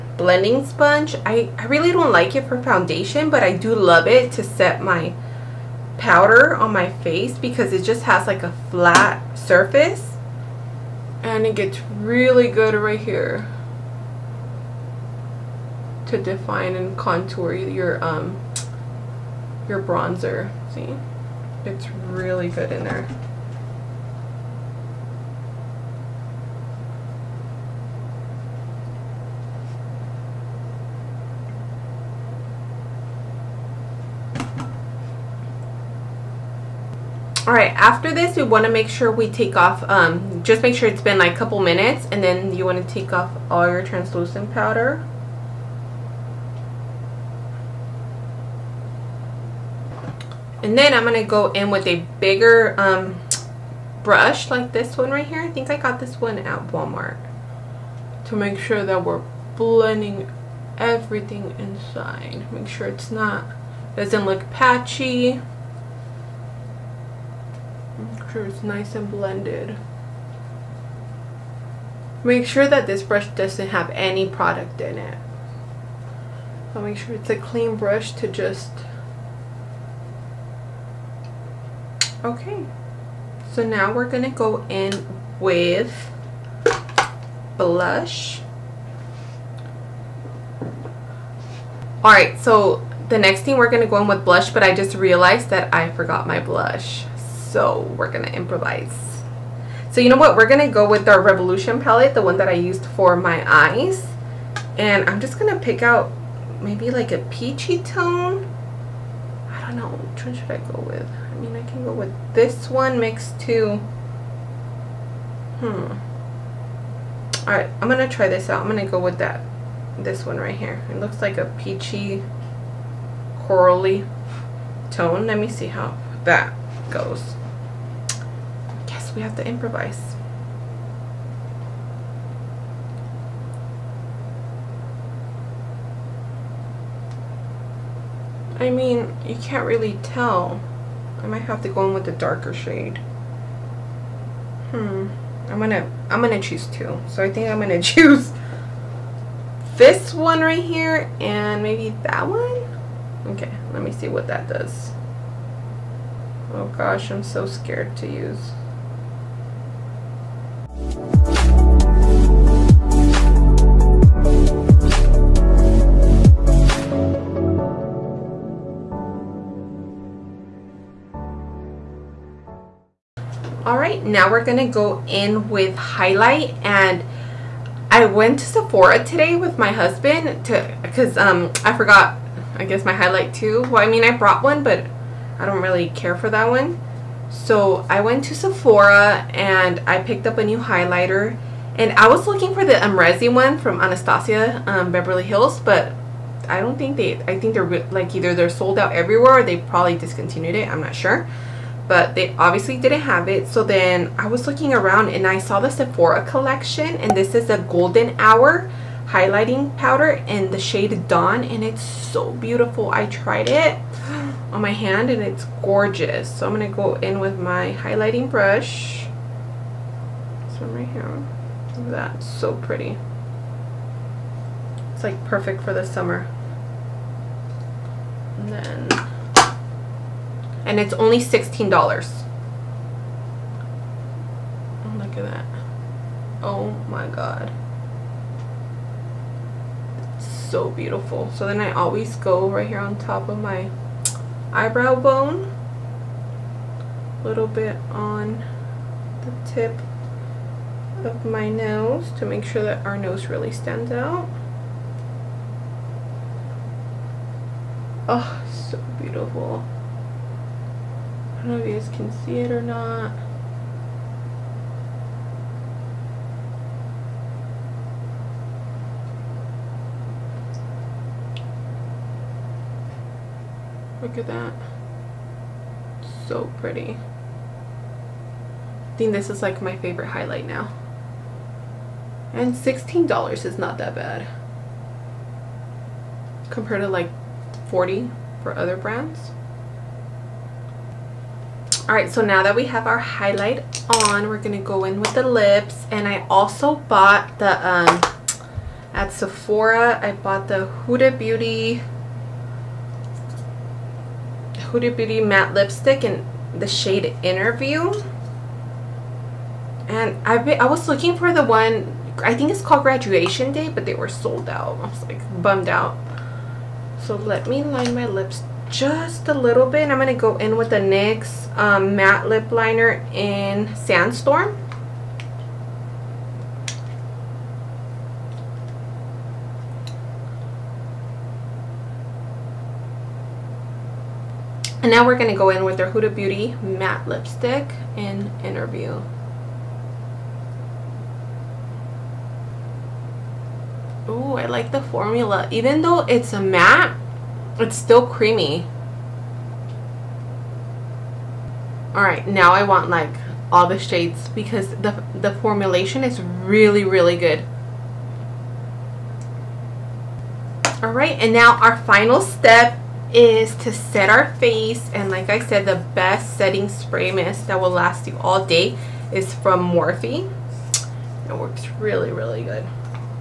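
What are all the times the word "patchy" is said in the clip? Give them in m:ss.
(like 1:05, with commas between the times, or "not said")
1:04.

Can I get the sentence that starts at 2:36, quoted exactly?
Oh gosh, I'm so scared to use.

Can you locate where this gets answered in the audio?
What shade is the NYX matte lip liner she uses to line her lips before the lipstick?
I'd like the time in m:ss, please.
5:23.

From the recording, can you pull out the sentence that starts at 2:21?
I might have to go in with the darker shade.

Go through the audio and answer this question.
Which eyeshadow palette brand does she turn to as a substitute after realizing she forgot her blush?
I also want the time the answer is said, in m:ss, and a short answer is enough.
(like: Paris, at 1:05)
Revolution, at 1:41.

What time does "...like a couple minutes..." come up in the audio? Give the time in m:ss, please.
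0:41.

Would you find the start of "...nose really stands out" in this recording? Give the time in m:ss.
4:12.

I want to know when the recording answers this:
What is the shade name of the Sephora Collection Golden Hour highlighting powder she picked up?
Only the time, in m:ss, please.
3:31.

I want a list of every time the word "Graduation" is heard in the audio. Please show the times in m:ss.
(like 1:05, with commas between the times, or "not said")
5:12.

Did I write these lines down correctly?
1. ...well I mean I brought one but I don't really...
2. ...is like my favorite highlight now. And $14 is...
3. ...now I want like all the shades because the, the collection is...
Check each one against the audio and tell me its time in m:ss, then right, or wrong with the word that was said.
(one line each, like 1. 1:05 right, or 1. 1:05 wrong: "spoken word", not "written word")
1. 3:03 right
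2. 4:39 wrong: "16", not "14"
3. 5:52 wrong: "formulation", not "collection".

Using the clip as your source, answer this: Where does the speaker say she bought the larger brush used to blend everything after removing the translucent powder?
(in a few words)
Walmart.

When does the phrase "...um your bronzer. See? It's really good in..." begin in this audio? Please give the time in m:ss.
0:18.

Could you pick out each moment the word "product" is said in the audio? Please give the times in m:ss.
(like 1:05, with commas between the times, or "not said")
1:14.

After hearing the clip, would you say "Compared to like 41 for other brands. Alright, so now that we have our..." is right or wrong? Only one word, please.
wrong.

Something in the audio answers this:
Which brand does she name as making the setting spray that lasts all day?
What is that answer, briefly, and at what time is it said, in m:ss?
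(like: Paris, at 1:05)
Morphe, at 6:09.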